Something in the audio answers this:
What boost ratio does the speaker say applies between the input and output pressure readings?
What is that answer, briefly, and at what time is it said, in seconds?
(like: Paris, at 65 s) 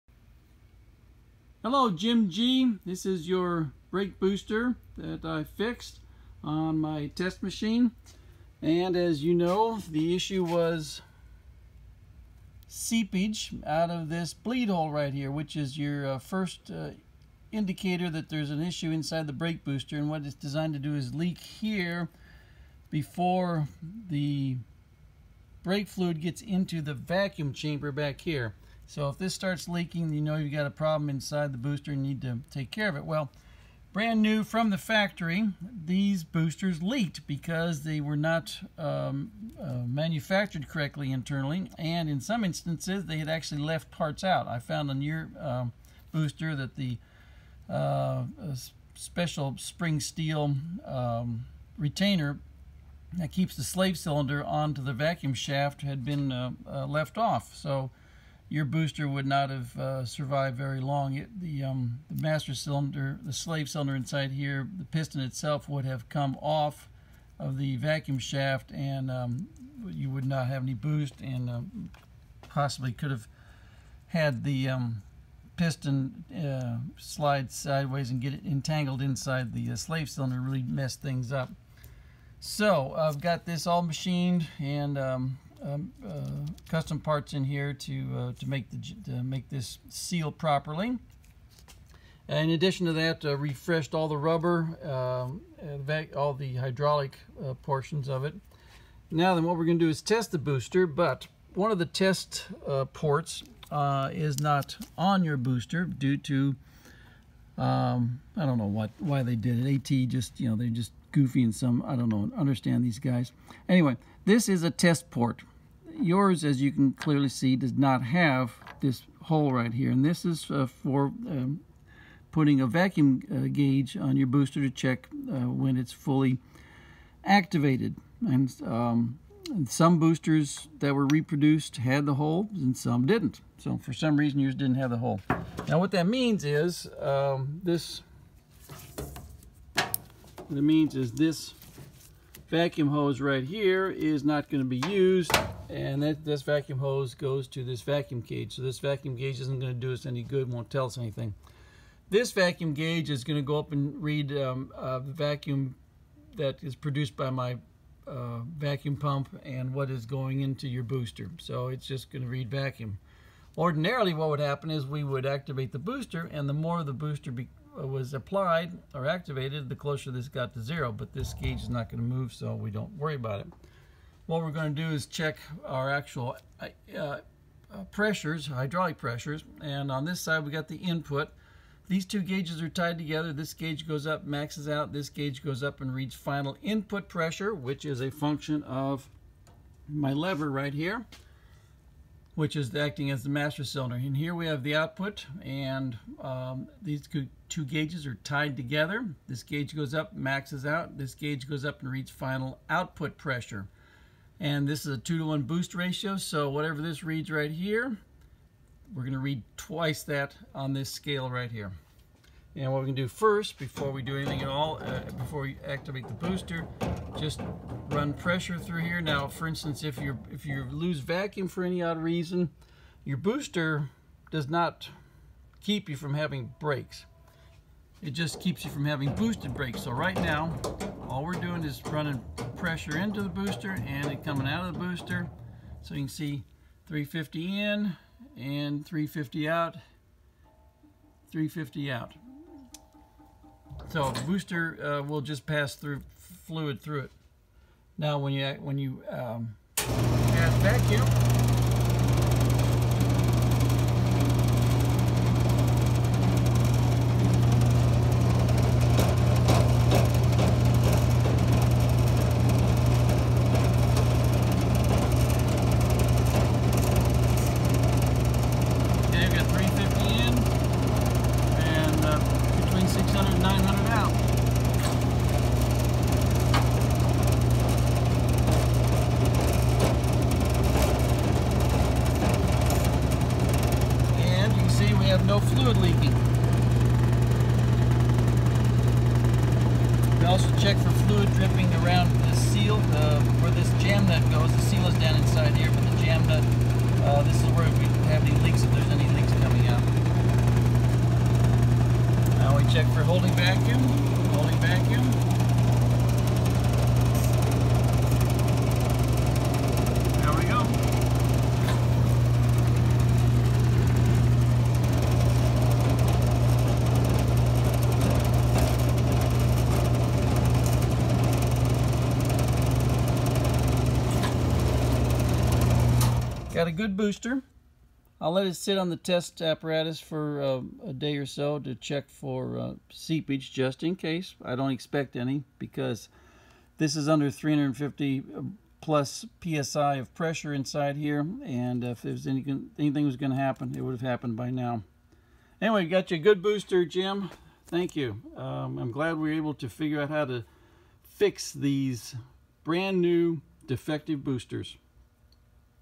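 2 to 1, at 204 s.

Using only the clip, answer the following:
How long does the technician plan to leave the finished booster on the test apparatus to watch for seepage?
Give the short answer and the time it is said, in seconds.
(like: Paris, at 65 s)
a day or so, at 330 s.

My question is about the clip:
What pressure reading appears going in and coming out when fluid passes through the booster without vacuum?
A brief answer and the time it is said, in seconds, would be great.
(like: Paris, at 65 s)
350, at 236 s.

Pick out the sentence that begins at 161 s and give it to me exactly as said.
So it's just going to read vacuum.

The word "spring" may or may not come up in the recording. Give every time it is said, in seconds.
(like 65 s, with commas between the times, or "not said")
49 s.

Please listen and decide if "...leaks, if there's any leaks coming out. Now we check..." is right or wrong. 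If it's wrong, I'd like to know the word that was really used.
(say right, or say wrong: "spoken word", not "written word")
right.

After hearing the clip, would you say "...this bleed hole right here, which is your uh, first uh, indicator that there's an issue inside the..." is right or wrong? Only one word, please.
right.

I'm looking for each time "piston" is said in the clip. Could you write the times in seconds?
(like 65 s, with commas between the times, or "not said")
64 s, 75 s.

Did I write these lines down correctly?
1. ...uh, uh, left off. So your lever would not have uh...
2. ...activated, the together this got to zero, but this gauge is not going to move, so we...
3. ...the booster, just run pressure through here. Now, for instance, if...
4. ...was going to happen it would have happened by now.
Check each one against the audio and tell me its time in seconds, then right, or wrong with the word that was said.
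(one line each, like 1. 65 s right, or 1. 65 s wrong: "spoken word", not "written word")
1. 56 s wrong: "booster", not "lever"
2. 169 s wrong: "closer", not "together"
3. 216 s right
4. 343 s right.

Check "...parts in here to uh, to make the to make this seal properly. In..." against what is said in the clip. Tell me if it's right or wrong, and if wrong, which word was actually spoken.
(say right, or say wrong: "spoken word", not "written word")
right.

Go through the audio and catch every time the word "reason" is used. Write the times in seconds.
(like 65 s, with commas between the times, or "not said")
134 s, 221 s.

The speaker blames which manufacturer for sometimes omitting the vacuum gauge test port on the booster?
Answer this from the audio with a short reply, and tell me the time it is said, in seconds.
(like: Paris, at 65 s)
ATE, at 109 s.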